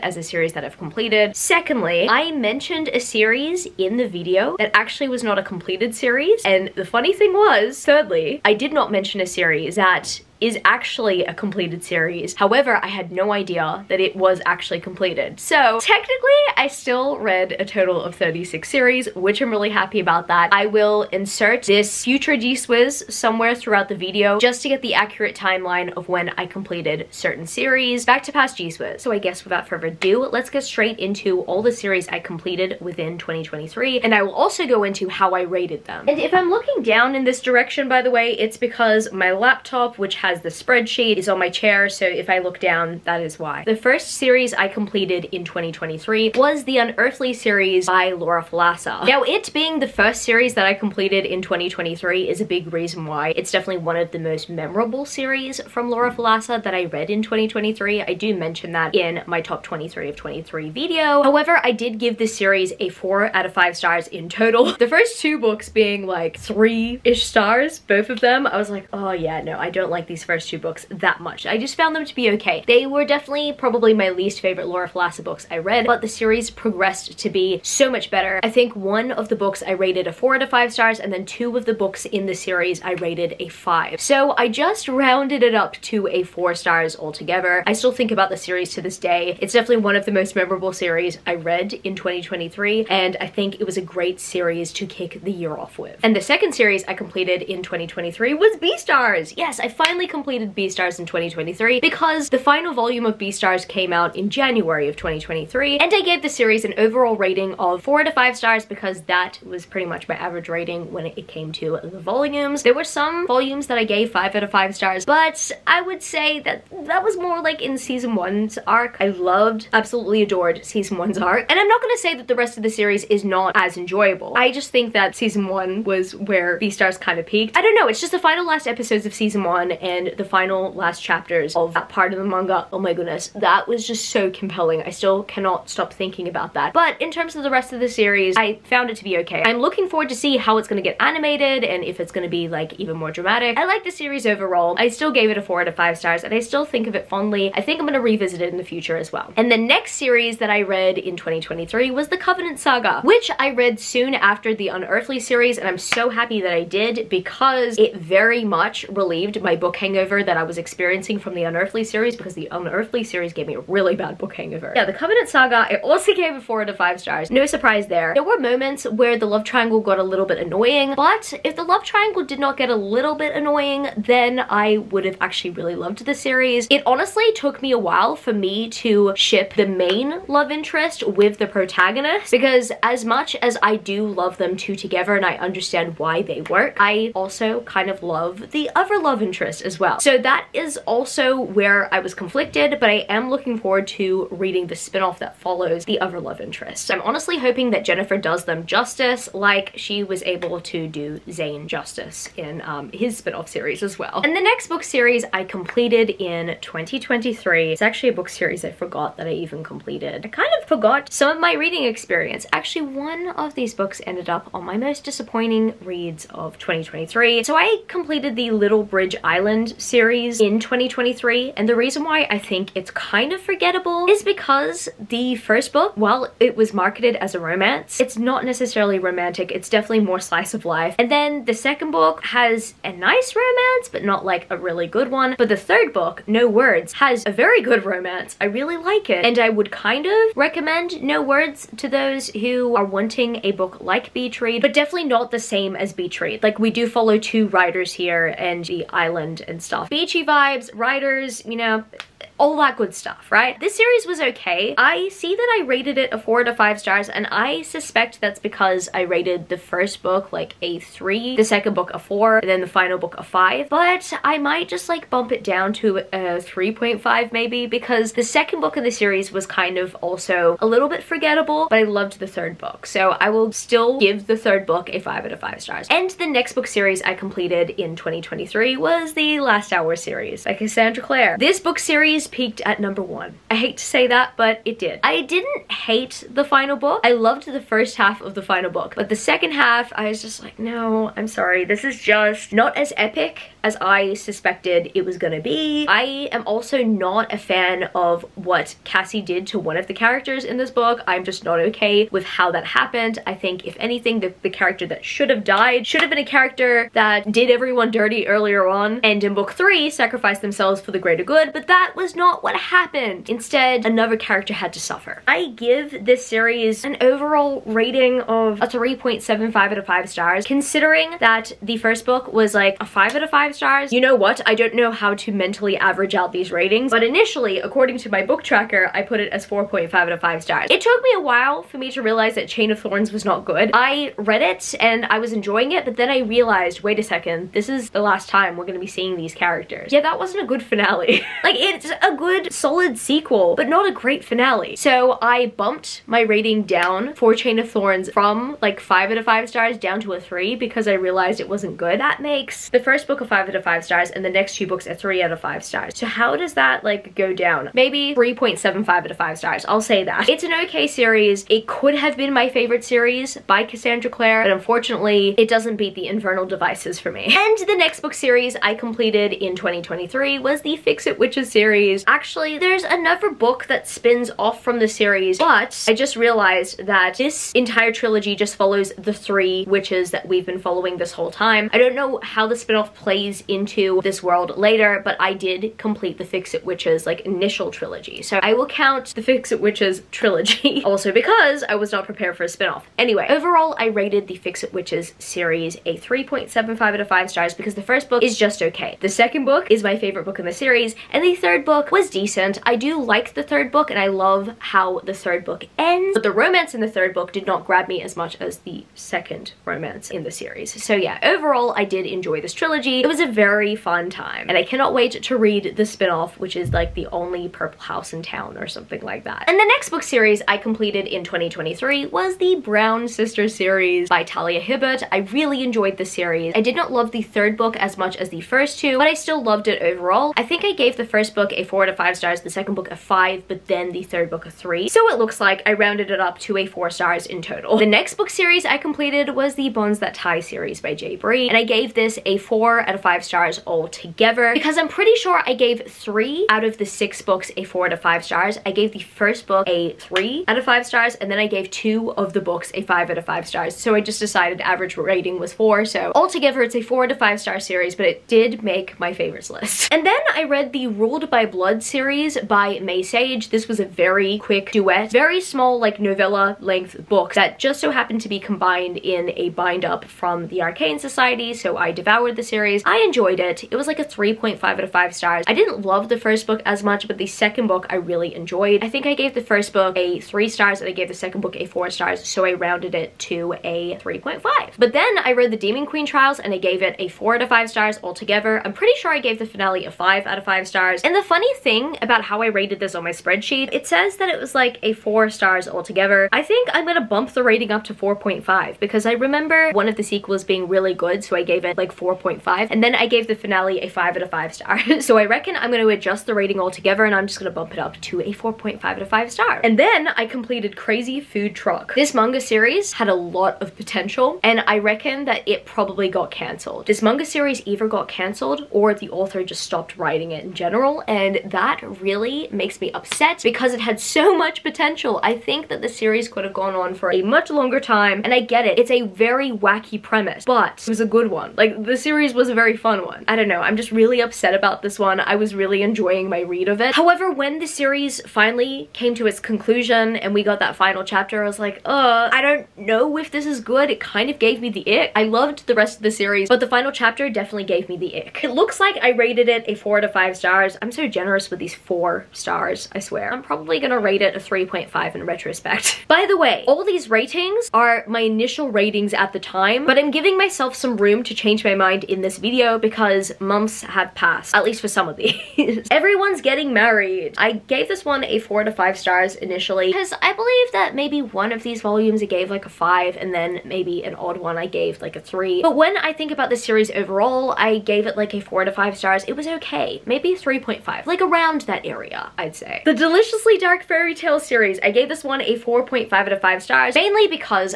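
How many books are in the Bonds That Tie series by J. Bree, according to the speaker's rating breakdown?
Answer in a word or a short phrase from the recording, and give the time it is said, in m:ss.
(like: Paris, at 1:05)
6, at 7:26.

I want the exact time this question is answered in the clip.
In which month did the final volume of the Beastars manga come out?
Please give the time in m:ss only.
1:44.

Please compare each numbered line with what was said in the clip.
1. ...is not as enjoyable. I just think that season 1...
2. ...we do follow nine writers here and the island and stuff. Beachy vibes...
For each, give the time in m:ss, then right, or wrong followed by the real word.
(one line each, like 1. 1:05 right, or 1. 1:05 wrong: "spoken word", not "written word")
1. 2:03 right
2. 4:06 wrong: "two", not "nine".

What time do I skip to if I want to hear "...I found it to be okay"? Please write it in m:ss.
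2:18.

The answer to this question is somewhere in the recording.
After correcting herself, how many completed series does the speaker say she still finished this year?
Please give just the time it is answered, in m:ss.
0:18.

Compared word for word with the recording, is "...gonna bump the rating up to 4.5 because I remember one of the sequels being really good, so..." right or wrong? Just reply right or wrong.
right.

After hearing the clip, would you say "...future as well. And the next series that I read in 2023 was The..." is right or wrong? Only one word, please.
right.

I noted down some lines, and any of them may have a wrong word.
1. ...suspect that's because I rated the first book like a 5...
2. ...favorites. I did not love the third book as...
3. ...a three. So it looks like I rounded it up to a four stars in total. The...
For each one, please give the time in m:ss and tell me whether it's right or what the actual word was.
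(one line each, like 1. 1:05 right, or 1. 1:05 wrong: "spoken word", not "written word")
1. 4:17 wrong: "3", not "5"
2. 7:06 wrong: "series", not "favorites"
3. 7:14 right.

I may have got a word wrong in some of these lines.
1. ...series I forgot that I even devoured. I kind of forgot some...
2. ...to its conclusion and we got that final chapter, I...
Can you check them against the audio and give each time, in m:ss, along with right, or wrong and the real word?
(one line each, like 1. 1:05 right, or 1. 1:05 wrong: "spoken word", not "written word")
1. 3:28 wrong: "completed", not "devoured"
2. 8:59 right.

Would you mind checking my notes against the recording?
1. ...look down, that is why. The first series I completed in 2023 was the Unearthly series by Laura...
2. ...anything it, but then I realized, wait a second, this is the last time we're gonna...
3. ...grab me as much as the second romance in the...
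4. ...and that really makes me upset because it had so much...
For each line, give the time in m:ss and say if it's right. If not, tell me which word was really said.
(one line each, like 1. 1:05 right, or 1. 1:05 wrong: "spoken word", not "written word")
1. 0:42 right
2. 5:35 wrong: "enjoying", not "anything"
3. 6:47 right
4. 8:41 right.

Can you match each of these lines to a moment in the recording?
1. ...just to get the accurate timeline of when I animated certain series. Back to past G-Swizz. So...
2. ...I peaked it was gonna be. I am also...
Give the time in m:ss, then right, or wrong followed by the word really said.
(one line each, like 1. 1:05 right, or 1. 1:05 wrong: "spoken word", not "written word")
1. 0:24 wrong: "completed", not "animated"
2. 4:53 wrong: "suspected", not "peaked".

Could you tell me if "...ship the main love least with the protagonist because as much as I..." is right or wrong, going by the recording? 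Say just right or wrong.
wrong.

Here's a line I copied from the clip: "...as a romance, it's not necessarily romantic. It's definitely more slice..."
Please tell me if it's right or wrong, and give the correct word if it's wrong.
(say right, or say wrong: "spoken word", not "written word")
right.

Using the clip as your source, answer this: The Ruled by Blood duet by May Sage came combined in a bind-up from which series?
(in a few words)
the Arcane Society.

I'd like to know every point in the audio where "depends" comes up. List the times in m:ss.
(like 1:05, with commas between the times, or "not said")
not said.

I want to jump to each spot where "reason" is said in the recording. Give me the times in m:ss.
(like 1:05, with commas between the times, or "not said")
0:52, 3:41.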